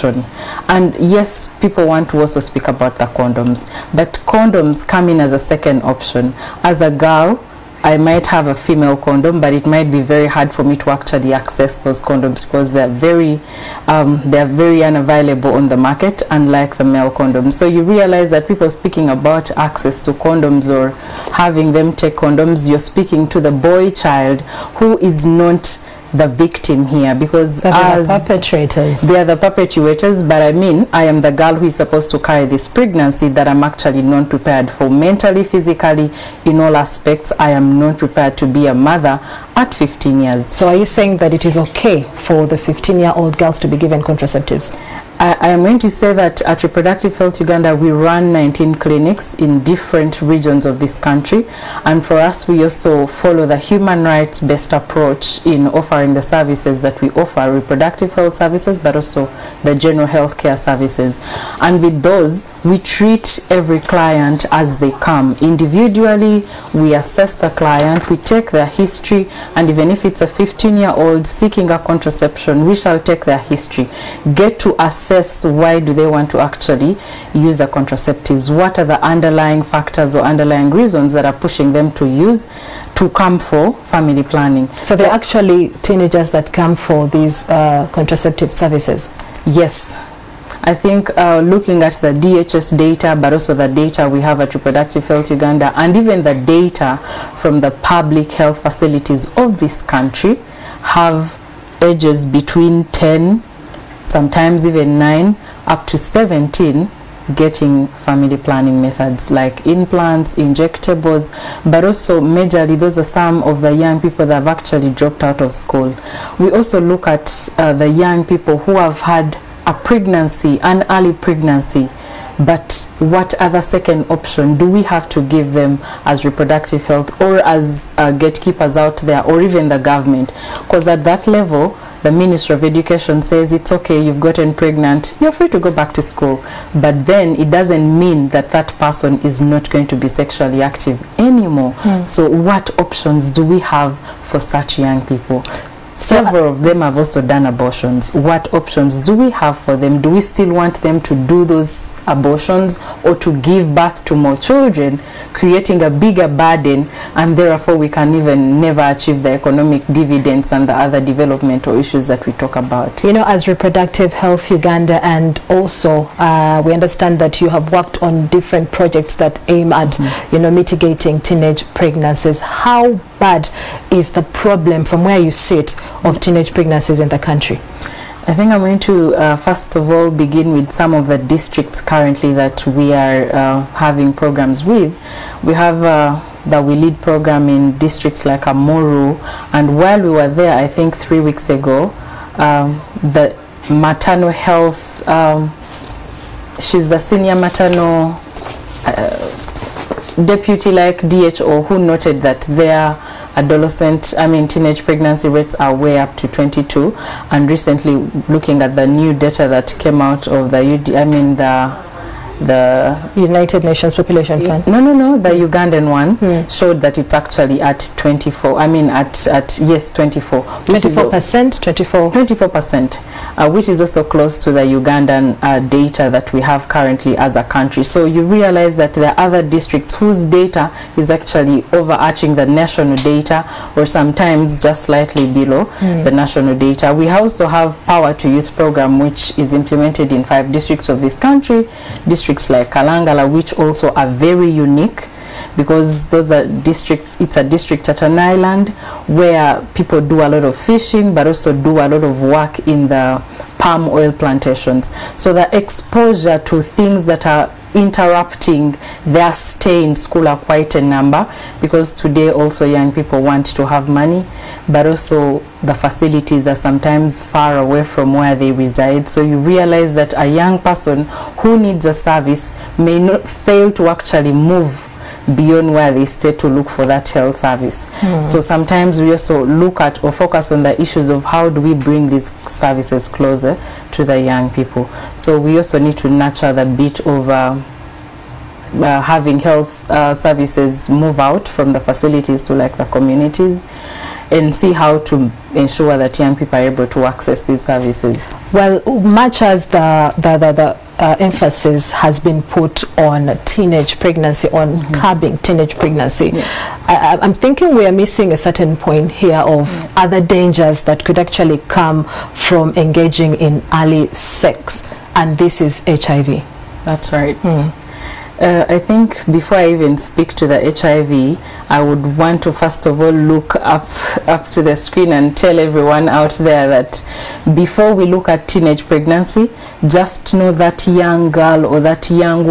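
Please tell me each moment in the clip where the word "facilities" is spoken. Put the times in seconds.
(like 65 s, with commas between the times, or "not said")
98 s, 265 s, 291 s.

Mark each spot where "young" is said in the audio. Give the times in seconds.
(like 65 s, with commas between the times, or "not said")
113 s, 117 s, 144 s, 262 s, 270 s, 284 s, 296 s, 330 s.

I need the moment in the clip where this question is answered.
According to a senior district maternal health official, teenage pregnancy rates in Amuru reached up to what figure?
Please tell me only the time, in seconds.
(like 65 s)
206 s.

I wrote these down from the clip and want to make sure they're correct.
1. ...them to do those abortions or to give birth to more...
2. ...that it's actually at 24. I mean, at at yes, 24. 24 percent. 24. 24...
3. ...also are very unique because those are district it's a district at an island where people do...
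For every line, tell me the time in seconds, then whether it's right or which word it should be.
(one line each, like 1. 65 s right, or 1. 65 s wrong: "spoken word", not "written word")
1. 150 s right
2. 216 s right
3. 243 s right.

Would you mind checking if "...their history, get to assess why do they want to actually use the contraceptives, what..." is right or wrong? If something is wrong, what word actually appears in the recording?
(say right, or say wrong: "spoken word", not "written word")
right.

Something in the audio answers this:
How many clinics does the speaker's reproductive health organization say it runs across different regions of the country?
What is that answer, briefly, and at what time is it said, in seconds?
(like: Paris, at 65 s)
19, at 48 s.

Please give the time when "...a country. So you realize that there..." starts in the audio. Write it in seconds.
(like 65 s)
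227 s.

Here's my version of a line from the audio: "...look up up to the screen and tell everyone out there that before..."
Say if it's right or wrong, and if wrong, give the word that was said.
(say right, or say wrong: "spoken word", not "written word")
right.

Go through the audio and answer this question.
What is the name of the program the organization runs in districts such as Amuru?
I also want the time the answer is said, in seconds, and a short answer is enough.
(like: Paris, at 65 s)
We Lead, at 186 s.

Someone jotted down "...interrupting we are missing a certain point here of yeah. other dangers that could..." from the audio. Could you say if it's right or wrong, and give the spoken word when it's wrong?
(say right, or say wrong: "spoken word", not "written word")
wrong: "thinking", not "interrupting".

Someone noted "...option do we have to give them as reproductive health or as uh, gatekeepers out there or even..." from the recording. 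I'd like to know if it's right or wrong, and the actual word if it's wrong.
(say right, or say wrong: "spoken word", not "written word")
right.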